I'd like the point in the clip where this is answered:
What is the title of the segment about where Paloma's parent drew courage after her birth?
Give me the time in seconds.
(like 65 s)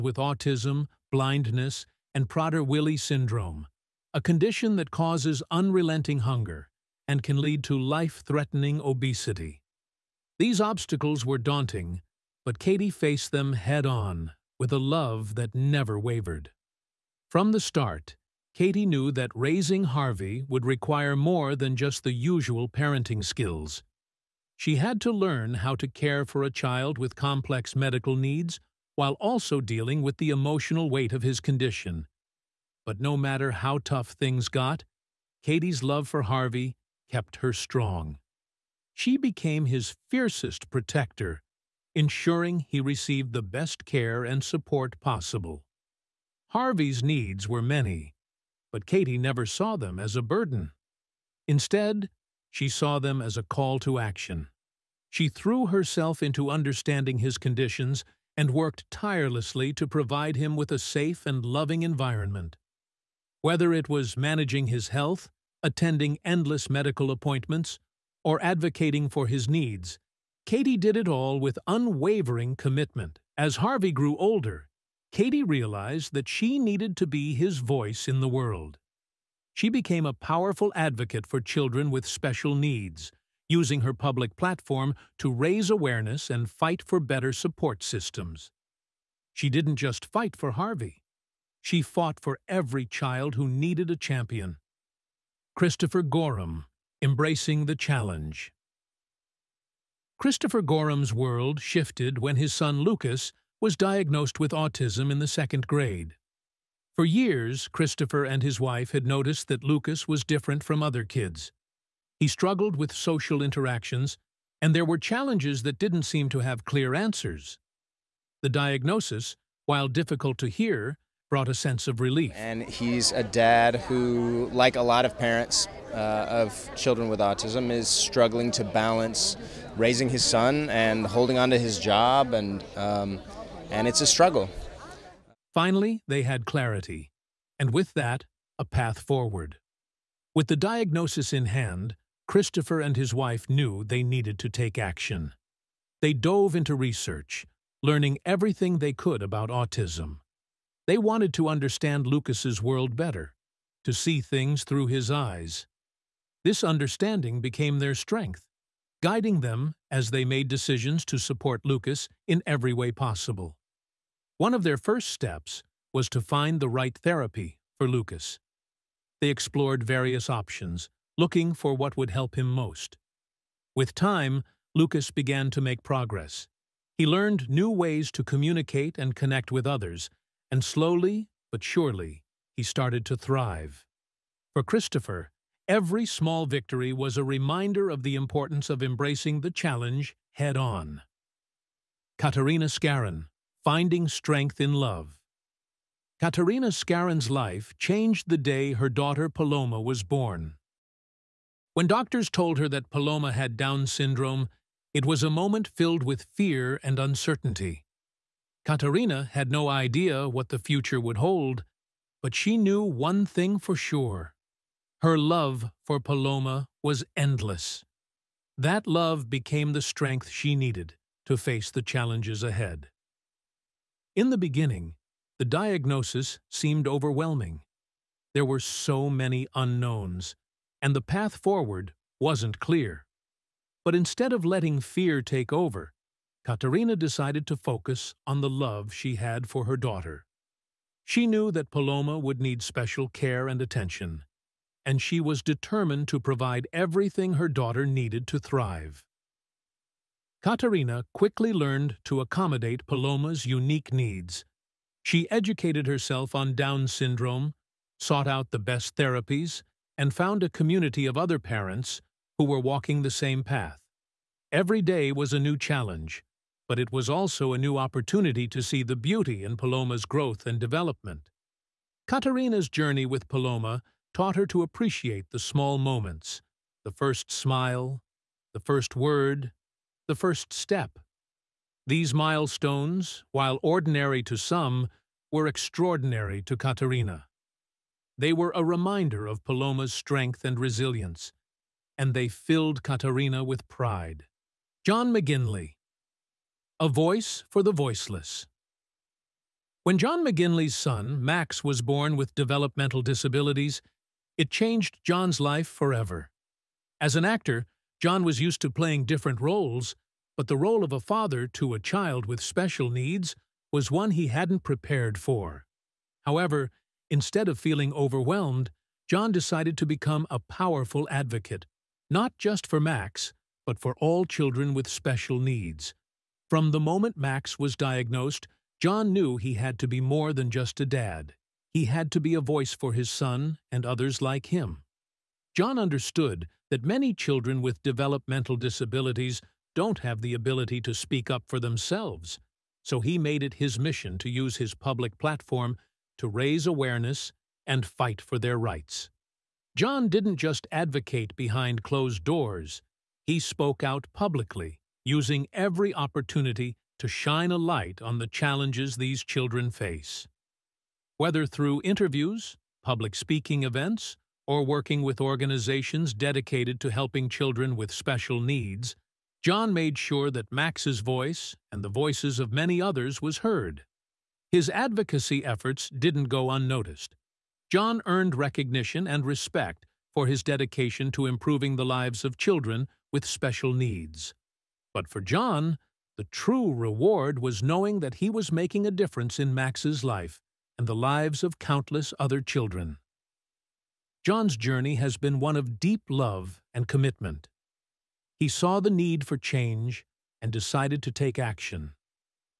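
193 s.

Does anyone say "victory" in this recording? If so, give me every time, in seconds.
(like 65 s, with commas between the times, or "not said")
186 s.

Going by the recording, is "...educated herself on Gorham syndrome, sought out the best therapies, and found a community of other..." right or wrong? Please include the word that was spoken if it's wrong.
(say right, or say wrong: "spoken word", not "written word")
wrong: "Down", not "Gorham".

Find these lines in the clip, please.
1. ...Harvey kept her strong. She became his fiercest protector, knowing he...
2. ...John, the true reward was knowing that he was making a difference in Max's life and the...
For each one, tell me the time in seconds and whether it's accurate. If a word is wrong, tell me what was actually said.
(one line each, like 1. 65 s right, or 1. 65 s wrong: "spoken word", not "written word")
1. 36 s wrong: "ensuring", not "knowing"
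2. 385 s right.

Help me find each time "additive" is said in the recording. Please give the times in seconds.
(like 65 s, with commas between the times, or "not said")
not said.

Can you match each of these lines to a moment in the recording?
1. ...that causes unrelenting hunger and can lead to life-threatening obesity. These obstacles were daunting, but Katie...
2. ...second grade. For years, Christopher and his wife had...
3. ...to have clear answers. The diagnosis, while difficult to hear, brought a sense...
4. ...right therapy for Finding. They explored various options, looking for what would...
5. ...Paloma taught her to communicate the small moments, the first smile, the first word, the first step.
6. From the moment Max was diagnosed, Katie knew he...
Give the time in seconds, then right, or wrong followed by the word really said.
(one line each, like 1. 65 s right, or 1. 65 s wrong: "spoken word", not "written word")
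1. 4 s right
2. 105 s right
3. 116 s right
4. 166 s wrong: "Lucas", not "Finding"
5. 273 s wrong: "appreciate", not "communicate"
6. 326 s wrong: "John", not "Katie".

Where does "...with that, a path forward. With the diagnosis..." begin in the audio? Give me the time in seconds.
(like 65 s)
137 s.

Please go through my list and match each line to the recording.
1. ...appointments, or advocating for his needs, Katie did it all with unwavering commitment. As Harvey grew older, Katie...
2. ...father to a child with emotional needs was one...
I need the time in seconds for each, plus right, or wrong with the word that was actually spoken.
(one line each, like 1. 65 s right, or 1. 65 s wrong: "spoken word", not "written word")
1. 67 s right
2. 310 s wrong: "special", not "emotional".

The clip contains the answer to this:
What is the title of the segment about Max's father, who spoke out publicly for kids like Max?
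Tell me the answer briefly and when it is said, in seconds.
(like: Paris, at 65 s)
A Voice for the Voiceless, at 296 s.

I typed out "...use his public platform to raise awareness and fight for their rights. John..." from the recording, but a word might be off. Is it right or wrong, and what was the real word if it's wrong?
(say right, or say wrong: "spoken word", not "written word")
right.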